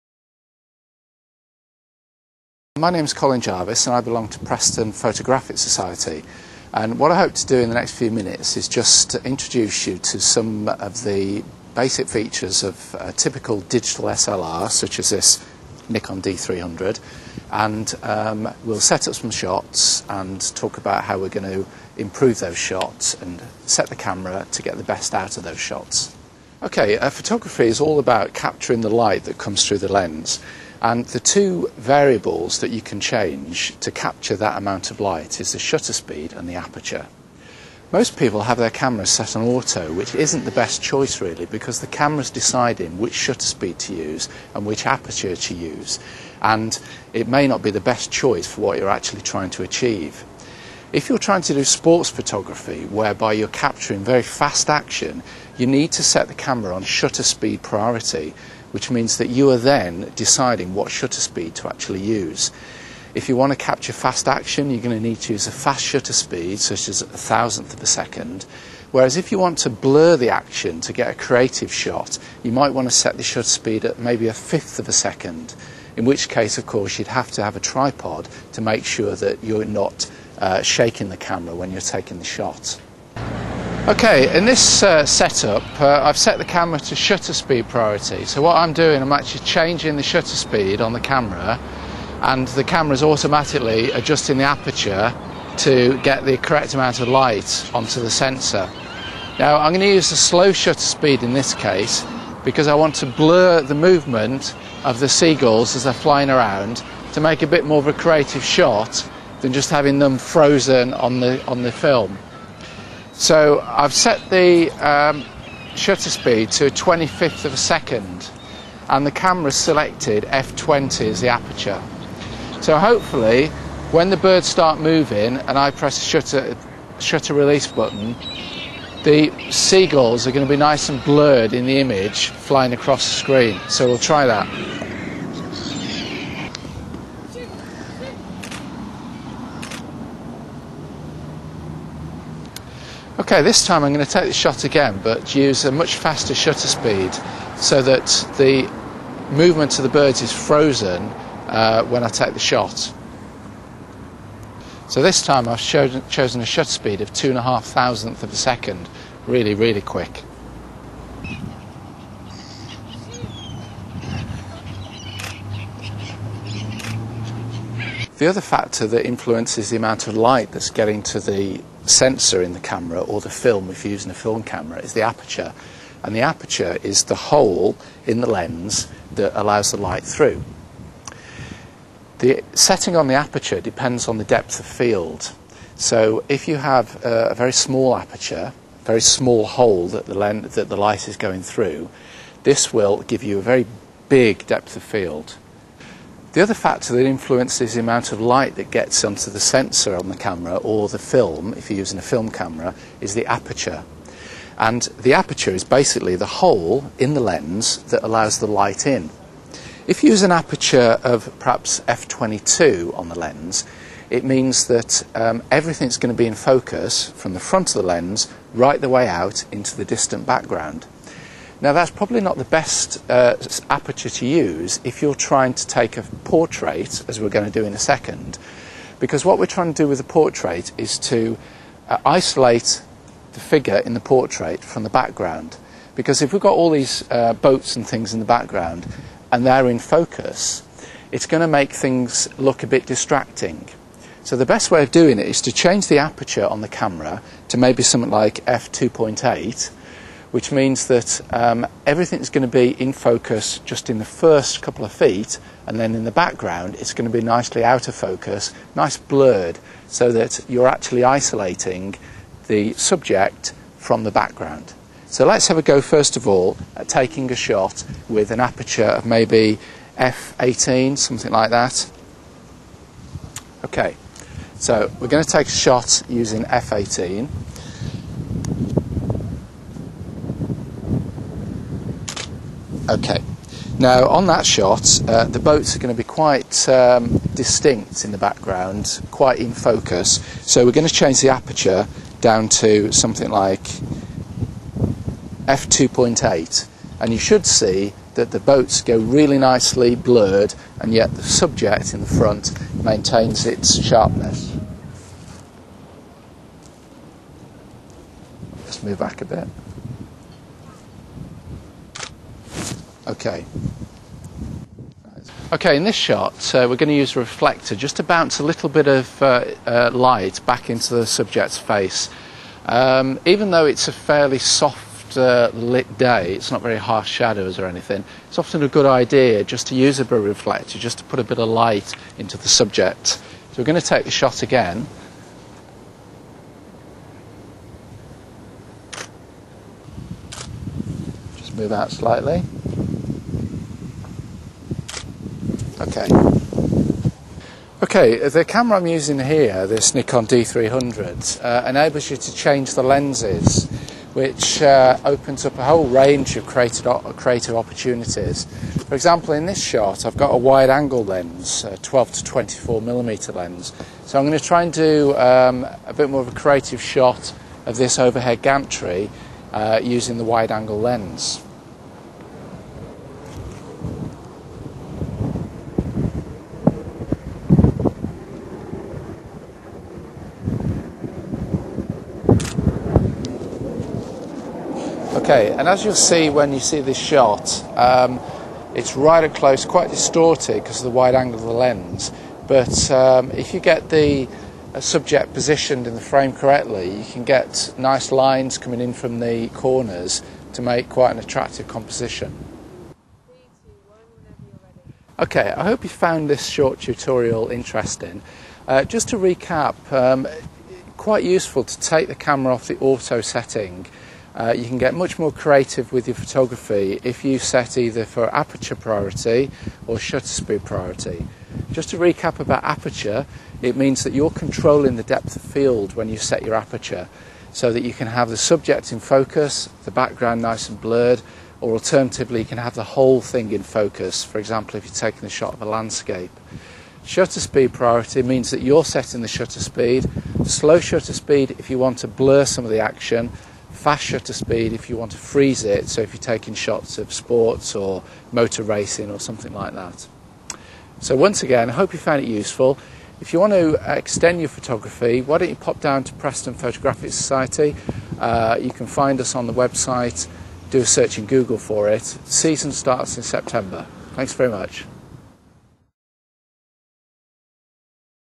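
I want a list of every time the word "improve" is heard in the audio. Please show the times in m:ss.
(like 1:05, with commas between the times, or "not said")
0:21.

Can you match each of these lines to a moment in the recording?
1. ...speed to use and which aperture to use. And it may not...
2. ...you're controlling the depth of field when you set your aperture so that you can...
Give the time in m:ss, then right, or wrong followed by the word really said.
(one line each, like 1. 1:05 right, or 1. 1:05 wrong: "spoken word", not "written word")
1. 0:43 right
2. 7:04 right.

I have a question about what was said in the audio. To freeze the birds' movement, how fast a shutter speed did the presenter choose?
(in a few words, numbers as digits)
2.5 thousandths of a second.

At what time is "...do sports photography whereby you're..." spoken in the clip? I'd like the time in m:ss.
0:51.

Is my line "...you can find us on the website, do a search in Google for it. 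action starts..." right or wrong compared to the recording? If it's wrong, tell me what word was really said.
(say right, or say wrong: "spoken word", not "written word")
wrong: "season", not "action".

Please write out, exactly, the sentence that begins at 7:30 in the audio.
So once again, I hope you found it useful.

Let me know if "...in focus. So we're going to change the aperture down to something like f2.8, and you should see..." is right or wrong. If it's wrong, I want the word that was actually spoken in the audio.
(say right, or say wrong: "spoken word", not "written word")
right.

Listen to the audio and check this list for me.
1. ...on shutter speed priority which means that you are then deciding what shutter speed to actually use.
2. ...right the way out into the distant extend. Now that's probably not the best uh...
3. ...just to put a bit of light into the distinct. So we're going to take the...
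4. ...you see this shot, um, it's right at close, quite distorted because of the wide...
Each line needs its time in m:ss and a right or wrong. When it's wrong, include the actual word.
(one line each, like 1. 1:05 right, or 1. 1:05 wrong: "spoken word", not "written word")
1. 0:56 right
2. 3:38 wrong: "background", not "extend"
3. 5:30 wrong: "subject", not "distinct"
4. 6:26 right.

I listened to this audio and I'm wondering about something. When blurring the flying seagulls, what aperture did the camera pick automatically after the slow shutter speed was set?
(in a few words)
f20.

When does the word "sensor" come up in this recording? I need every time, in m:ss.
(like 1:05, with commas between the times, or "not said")
1:38, 2:51, 3:19.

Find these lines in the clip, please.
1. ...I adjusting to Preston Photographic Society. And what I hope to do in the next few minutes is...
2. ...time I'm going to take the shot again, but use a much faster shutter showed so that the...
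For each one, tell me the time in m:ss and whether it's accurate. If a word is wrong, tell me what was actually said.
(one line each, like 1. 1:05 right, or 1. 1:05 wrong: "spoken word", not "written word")
1. 0:03 wrong: "belong", not "adjusting"
2. 2:23 wrong: "speed", not "showed".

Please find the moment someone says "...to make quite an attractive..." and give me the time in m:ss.
6:40.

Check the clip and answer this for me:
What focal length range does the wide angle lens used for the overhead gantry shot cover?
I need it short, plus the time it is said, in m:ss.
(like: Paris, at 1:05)
12 to 24mm, at 6:01.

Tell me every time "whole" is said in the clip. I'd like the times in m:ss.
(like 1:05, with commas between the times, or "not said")
5:55, 7:12.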